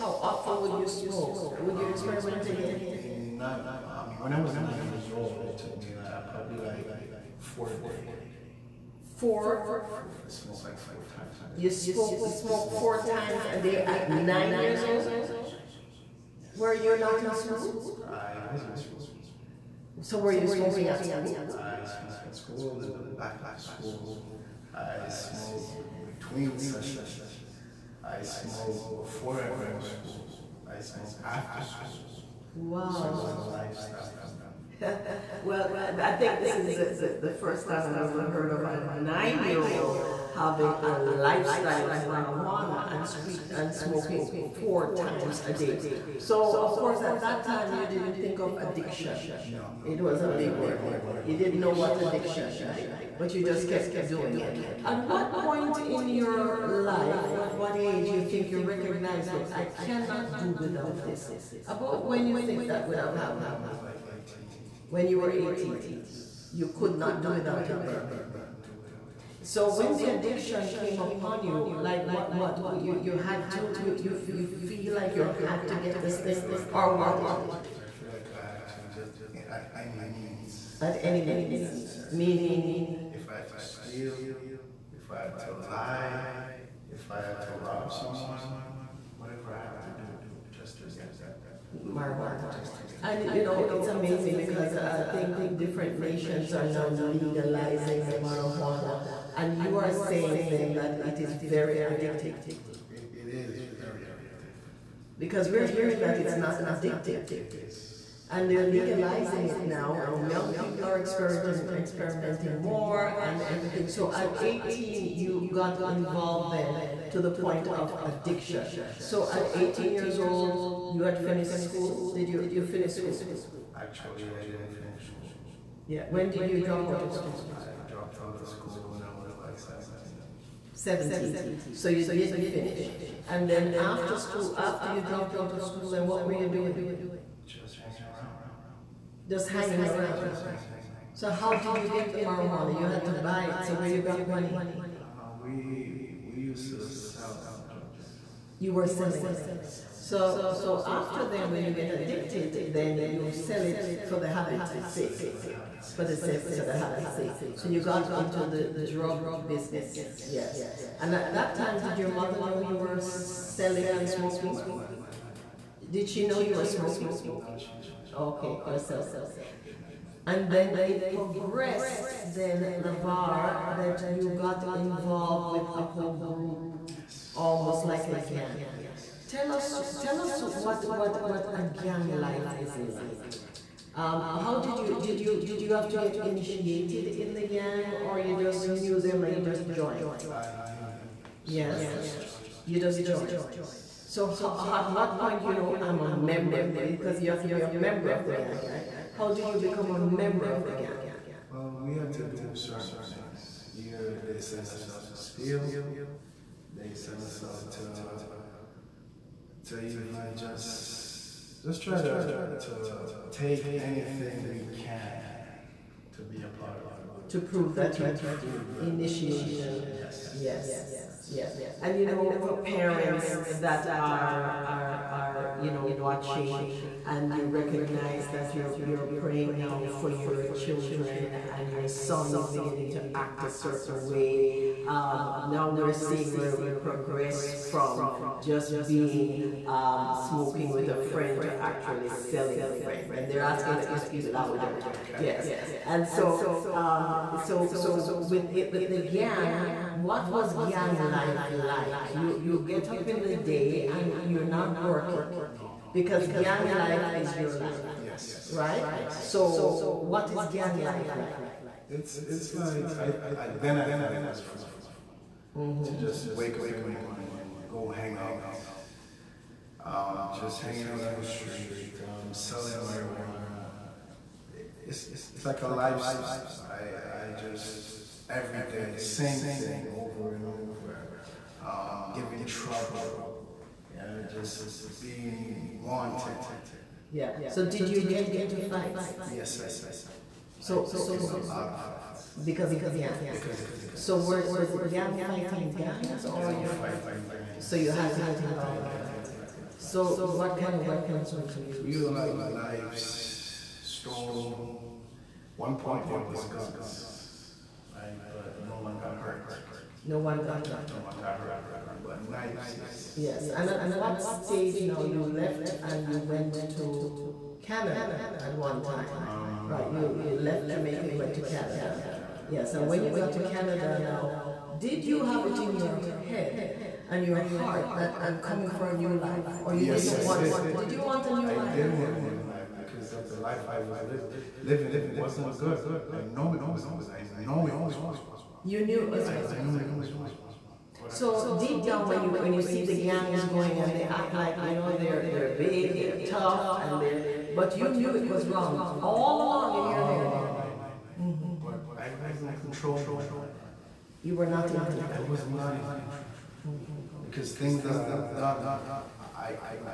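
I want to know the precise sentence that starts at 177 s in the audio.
almost like a gang yes Tell us, tell us what, what, what a gang life is like.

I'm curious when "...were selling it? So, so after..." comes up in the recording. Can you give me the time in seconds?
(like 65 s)
148 s.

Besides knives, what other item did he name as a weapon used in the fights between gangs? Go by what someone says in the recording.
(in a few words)
stone.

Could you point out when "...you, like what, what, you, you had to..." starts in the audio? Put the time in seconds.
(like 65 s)
71 s.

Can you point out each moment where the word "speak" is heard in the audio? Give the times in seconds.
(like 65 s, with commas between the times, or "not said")
43 s, 243 s.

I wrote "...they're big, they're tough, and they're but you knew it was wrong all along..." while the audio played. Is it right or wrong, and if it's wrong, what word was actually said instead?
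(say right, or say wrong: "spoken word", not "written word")
right.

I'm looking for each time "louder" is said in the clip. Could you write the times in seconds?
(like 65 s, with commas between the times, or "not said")
244 s.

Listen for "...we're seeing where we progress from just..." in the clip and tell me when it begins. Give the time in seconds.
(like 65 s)
235 s.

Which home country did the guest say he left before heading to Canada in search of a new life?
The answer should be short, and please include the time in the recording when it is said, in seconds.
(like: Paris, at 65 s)
Jamaica, at 320 s.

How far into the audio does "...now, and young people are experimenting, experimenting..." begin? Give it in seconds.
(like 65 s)
109 s.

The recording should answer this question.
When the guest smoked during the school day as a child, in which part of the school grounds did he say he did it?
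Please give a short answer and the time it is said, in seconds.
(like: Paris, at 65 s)
back of the school, at 22 s.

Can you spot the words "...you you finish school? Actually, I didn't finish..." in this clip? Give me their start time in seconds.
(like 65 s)
122 s.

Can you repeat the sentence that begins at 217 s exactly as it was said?
To prove that to you prove that initiation.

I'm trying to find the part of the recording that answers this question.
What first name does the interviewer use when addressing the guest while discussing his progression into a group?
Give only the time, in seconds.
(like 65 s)
172 s.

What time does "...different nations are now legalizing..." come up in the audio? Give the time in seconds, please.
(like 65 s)
95 s.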